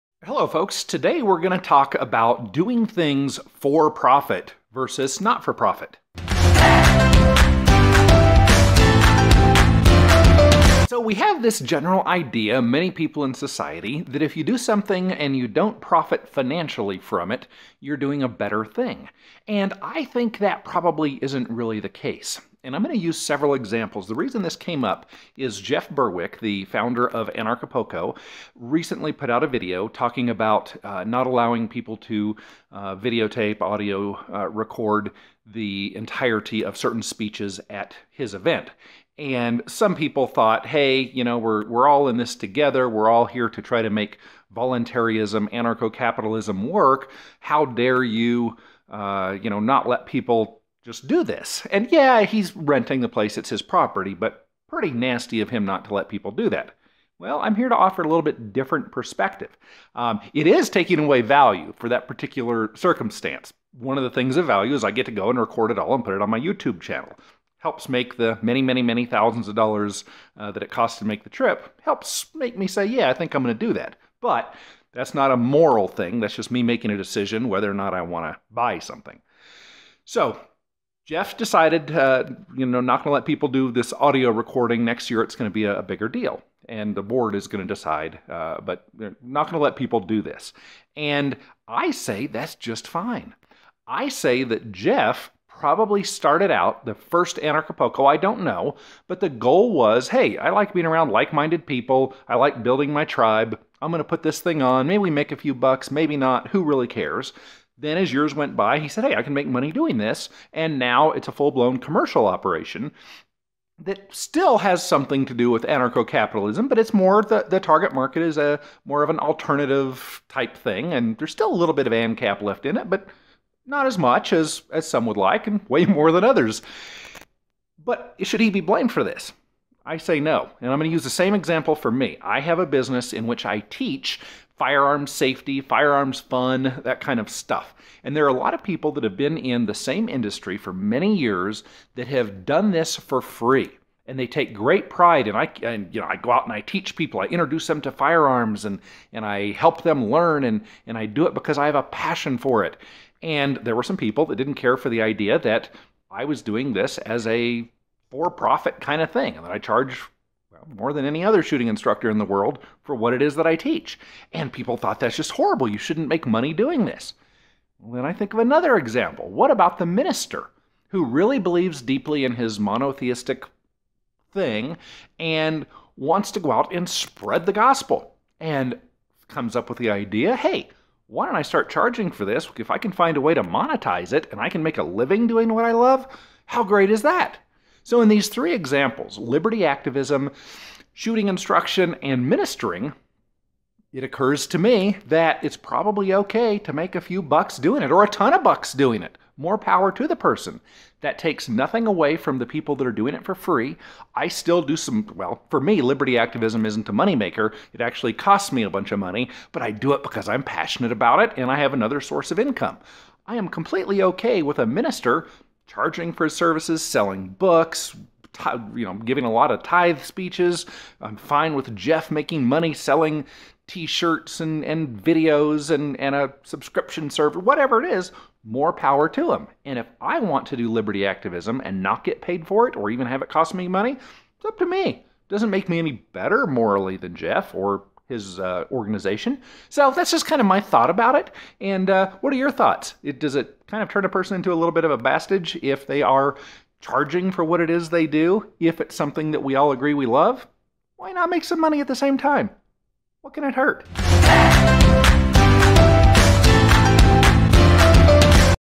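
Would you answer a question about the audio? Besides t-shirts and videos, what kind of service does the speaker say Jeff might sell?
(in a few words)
subscription service.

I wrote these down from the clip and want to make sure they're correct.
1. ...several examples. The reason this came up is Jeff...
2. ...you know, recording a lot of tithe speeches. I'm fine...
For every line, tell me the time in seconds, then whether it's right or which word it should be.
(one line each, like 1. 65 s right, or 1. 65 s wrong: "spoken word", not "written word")
1. 23 s right
2. 218 s wrong: "giving", not "recording".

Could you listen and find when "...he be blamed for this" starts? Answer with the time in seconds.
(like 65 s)
128 s.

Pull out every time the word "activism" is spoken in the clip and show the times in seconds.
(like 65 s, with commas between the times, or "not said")
189 s, 206 s, 231 s.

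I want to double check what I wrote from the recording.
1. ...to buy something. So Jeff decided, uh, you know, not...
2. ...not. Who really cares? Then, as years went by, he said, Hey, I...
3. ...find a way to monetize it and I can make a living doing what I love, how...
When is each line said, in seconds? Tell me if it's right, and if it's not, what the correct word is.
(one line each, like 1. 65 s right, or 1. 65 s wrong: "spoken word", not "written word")
1. 78 s right
2. 106 s right
3. 182 s right.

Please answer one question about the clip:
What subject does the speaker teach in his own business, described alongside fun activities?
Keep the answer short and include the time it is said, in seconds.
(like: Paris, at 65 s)
firearms safety, at 134 s.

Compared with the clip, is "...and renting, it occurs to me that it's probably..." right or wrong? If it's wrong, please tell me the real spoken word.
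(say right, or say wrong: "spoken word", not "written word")
wrong: "ministering", not "renting".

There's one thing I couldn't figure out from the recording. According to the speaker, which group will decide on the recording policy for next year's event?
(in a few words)
the board.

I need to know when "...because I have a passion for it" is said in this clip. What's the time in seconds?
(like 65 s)
151 s.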